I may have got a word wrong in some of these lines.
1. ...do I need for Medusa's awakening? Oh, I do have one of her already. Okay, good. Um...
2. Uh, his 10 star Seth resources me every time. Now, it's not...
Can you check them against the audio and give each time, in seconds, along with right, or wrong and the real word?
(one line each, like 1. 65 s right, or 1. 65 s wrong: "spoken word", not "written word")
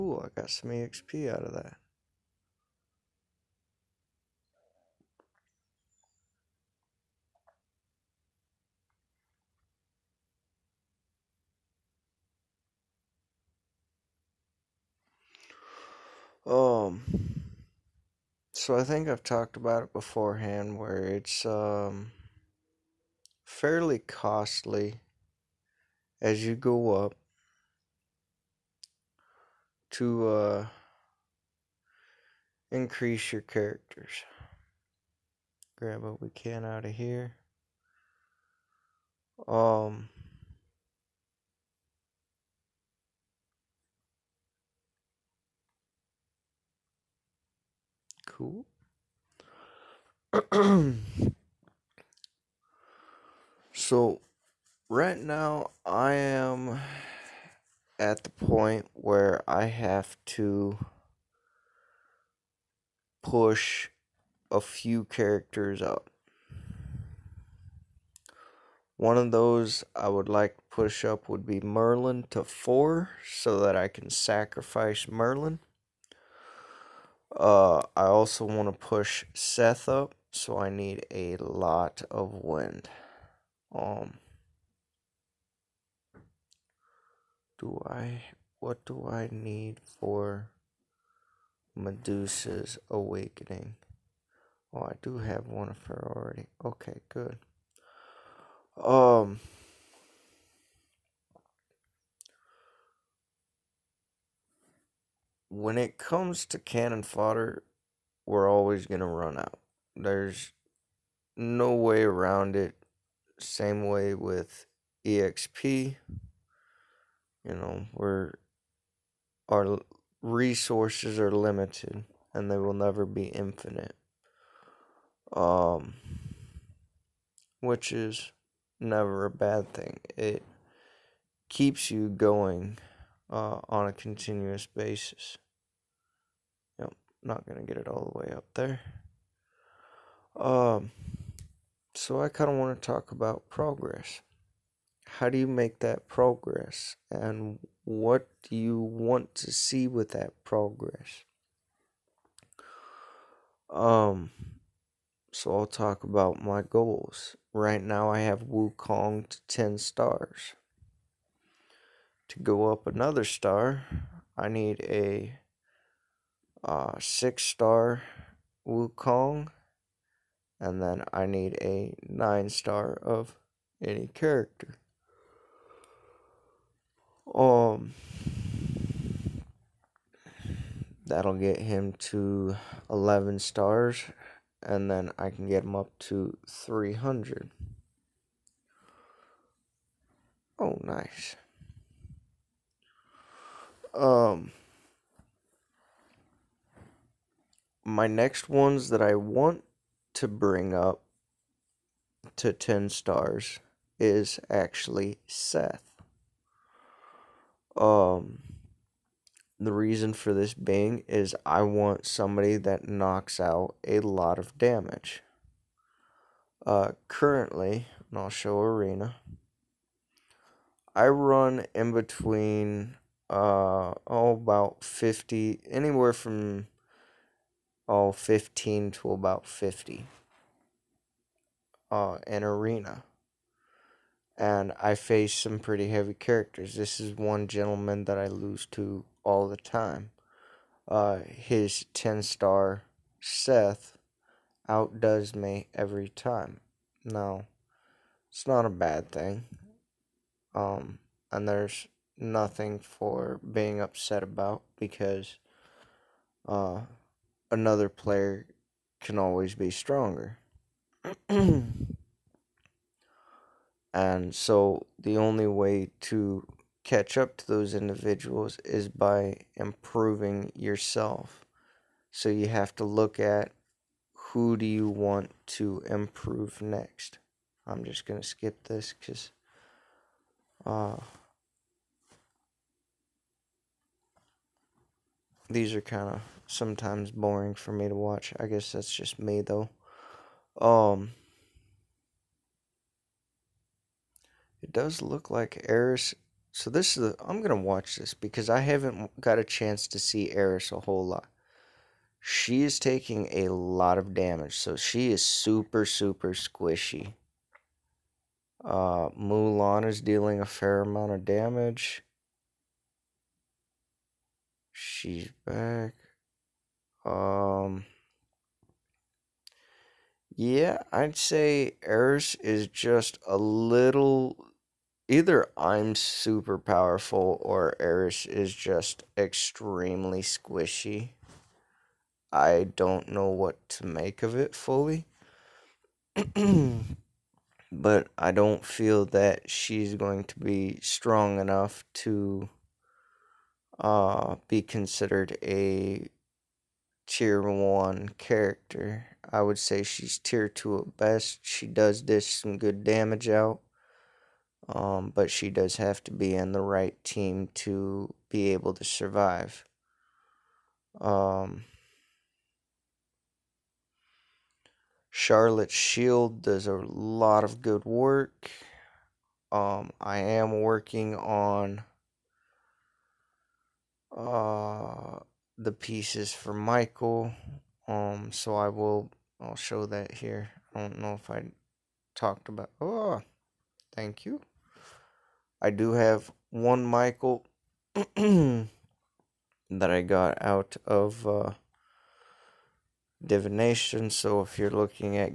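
1. 88 s right
2. 240 s wrong: "outdoes", not "resources".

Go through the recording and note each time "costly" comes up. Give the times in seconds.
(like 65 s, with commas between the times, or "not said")
23 s.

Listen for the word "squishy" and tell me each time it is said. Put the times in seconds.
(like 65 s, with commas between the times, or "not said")
306 s, 330 s.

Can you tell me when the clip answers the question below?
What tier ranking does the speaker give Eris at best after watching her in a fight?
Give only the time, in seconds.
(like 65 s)
350 s.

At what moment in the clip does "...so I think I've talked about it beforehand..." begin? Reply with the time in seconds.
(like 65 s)
18 s.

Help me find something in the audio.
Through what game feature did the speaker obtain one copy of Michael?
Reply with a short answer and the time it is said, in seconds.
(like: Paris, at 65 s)
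Divination, at 393 s.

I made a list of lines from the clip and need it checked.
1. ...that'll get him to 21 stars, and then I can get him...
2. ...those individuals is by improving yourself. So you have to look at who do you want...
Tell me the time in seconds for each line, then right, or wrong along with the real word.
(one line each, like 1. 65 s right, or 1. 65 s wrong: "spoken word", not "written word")
1. 181 s wrong: "11", not "21"
2. 267 s right.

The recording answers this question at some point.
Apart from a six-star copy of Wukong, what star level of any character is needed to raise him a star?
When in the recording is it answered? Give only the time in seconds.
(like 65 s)
172 s.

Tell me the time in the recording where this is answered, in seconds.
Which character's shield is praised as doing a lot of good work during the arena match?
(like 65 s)
365 s.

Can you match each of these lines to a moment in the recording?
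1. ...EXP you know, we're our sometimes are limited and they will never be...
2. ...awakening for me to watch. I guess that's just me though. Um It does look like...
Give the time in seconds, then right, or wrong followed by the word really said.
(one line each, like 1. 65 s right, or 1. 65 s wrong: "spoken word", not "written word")
1. 115 s wrong: "resources", not "sometimes"
2. 287 s wrong: "boring", not "awakening".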